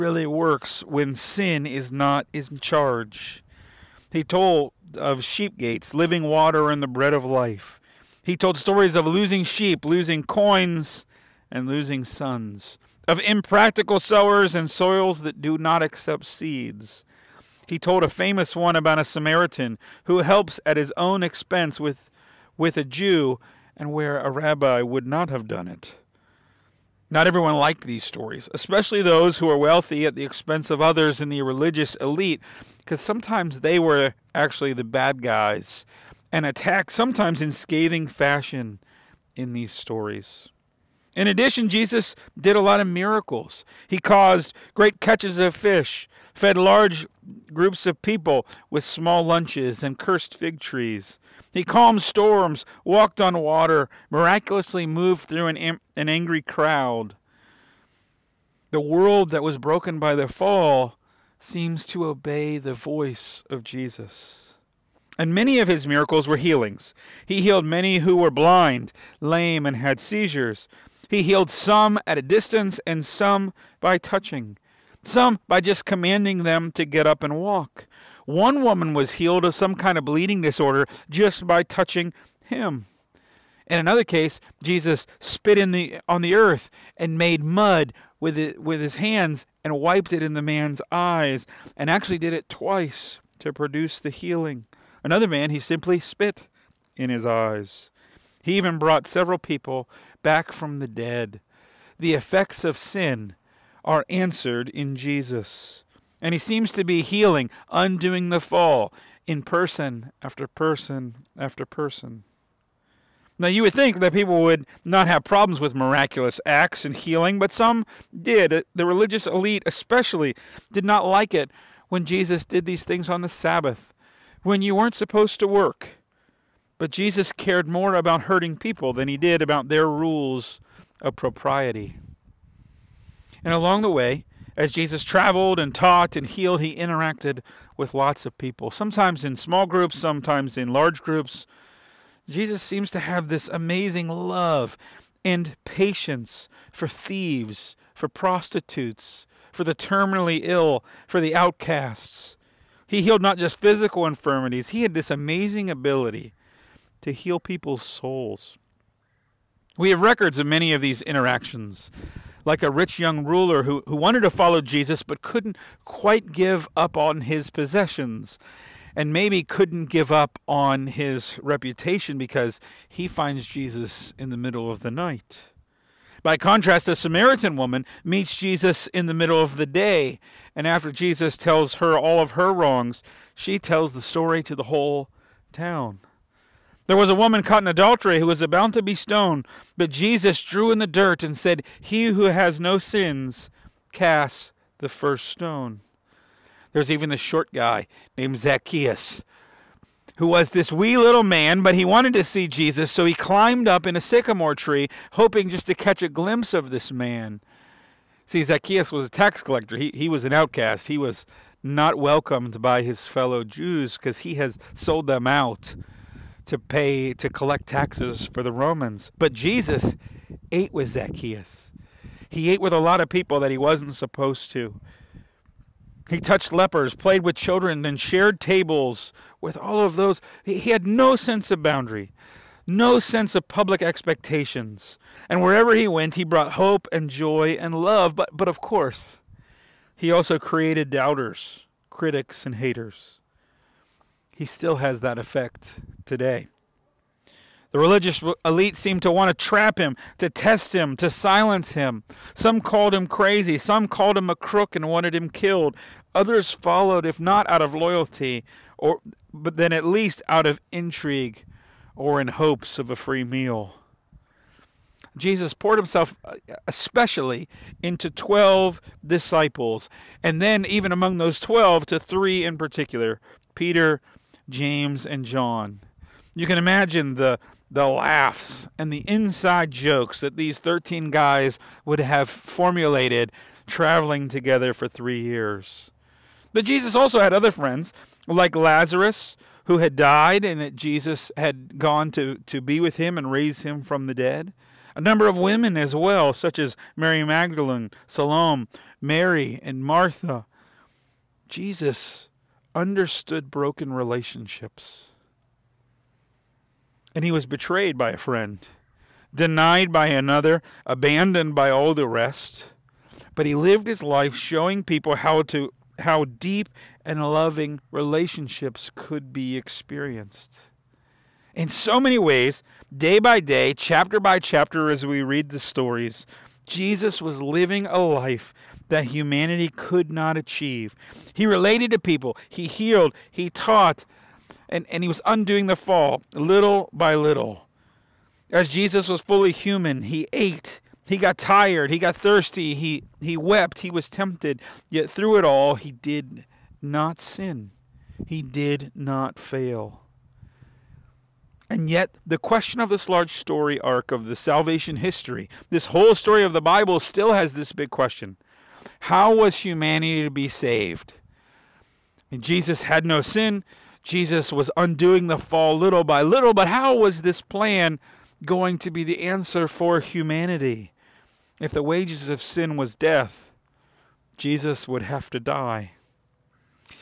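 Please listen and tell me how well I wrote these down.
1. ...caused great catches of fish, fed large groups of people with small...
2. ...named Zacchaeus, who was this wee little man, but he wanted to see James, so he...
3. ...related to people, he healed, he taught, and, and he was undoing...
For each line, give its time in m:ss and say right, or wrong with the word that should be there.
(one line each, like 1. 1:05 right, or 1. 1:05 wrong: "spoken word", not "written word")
1. 0:43 right
2. 3:18 wrong: "Jesus", not "James"
3. 5:31 right.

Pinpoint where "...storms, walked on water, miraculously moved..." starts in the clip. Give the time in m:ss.
0:52.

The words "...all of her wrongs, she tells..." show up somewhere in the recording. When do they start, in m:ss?
3:01.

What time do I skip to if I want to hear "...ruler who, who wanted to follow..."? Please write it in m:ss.
2:43.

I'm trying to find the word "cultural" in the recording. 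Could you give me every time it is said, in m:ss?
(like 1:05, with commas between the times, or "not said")
not said.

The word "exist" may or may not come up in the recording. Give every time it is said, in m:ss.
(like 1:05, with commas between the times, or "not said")
not said.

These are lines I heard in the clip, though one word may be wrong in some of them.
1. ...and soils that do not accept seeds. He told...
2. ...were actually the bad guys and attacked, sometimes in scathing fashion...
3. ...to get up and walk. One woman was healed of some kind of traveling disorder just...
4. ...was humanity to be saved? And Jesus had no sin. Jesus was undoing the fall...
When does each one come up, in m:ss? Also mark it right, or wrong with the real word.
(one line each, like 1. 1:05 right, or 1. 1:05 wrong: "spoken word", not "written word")
1. 0:14 right
2. 0:33 right
3. 1:16 wrong: "bleeding", not "traveling"
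4. 5:59 right.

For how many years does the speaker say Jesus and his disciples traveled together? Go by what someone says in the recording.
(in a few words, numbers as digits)
3.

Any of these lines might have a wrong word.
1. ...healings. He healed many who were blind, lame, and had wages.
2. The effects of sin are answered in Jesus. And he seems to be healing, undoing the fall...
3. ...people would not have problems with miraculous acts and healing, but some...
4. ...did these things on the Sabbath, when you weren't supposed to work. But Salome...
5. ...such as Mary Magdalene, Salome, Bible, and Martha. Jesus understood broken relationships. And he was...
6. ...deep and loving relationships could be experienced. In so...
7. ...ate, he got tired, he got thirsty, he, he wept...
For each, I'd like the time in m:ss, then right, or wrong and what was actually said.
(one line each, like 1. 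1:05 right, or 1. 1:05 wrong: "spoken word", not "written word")
1. 1:06 wrong: "seizures", not "wages"
2. 1:41 right
3. 1:54 right
4. 2:02 wrong: "Jesus", not "Salome"
5. 4:56 wrong: "Mary", not "Bible"
6. 5:16 right
7. 5:40 right.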